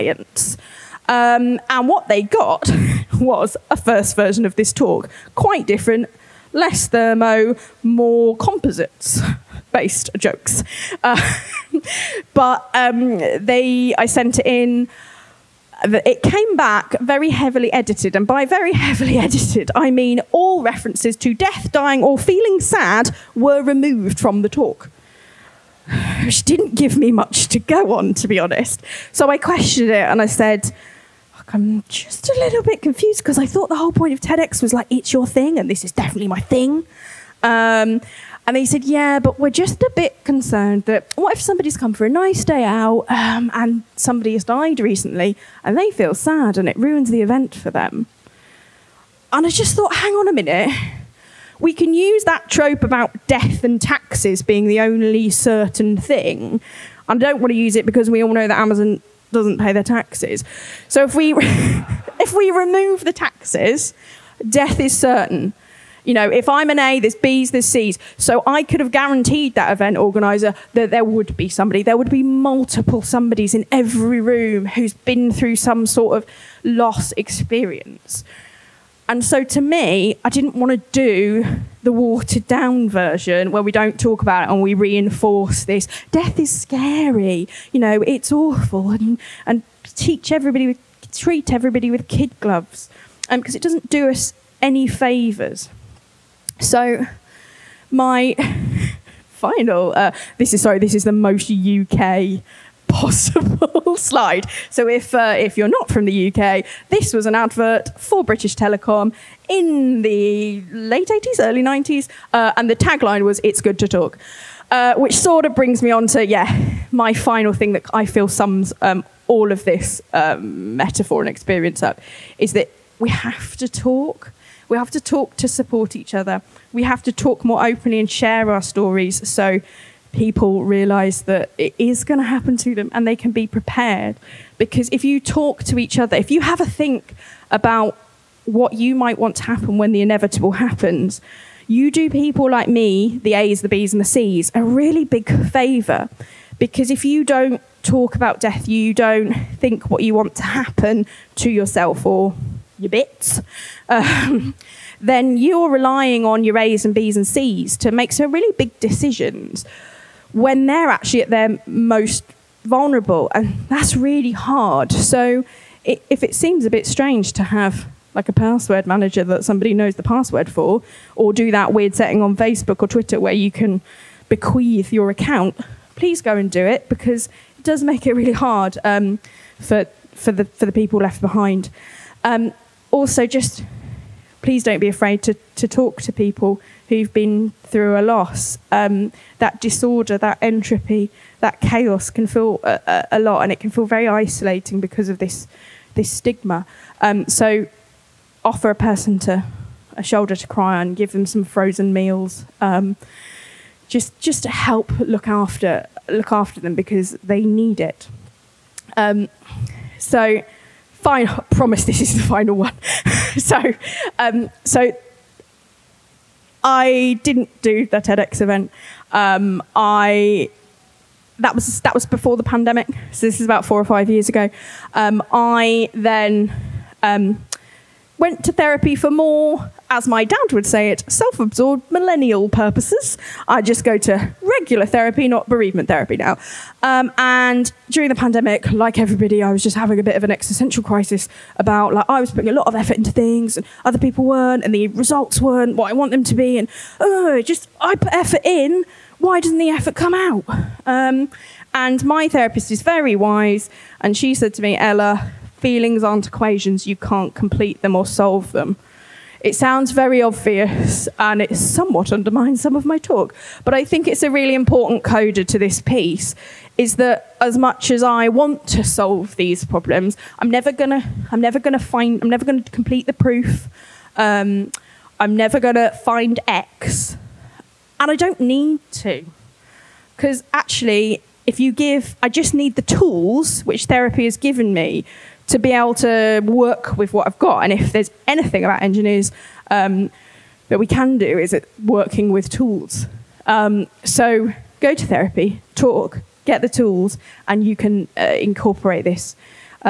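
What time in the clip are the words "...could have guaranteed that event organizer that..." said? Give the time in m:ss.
1:08.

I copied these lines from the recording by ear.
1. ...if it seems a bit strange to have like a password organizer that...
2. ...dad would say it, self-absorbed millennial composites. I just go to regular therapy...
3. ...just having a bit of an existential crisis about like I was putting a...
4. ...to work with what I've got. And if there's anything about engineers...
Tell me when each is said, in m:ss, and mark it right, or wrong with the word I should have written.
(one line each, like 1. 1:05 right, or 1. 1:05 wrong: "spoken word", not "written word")
1. 2:46 wrong: "manager", not "organizer"
2. 3:50 wrong: "purposes", not "composites"
3. 3:59 right
4. 4:45 right.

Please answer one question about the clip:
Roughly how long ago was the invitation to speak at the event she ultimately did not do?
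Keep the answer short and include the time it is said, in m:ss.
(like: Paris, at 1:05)
4 or 5 years, at 3:43.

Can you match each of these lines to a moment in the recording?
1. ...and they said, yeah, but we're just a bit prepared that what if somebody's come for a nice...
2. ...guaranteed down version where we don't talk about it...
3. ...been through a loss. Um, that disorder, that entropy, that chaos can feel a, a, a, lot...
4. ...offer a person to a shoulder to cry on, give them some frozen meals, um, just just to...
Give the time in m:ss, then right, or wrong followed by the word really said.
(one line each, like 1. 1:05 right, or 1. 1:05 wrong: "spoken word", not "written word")
1. 0:38 wrong: "concerned", not "prepared"
2. 1:21 wrong: "watered", not "guaranteed"
3. 3:07 right
4. 3:18 right.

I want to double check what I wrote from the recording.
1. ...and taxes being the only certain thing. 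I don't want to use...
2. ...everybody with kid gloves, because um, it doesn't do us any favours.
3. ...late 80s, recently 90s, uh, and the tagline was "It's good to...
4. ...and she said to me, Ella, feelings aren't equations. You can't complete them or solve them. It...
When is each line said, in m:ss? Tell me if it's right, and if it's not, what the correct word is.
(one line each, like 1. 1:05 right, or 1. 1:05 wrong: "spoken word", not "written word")
1. 0:53 right
2. 1:31 right
3. 1:50 wrong: "early", not "recently"
4. 4:13 right.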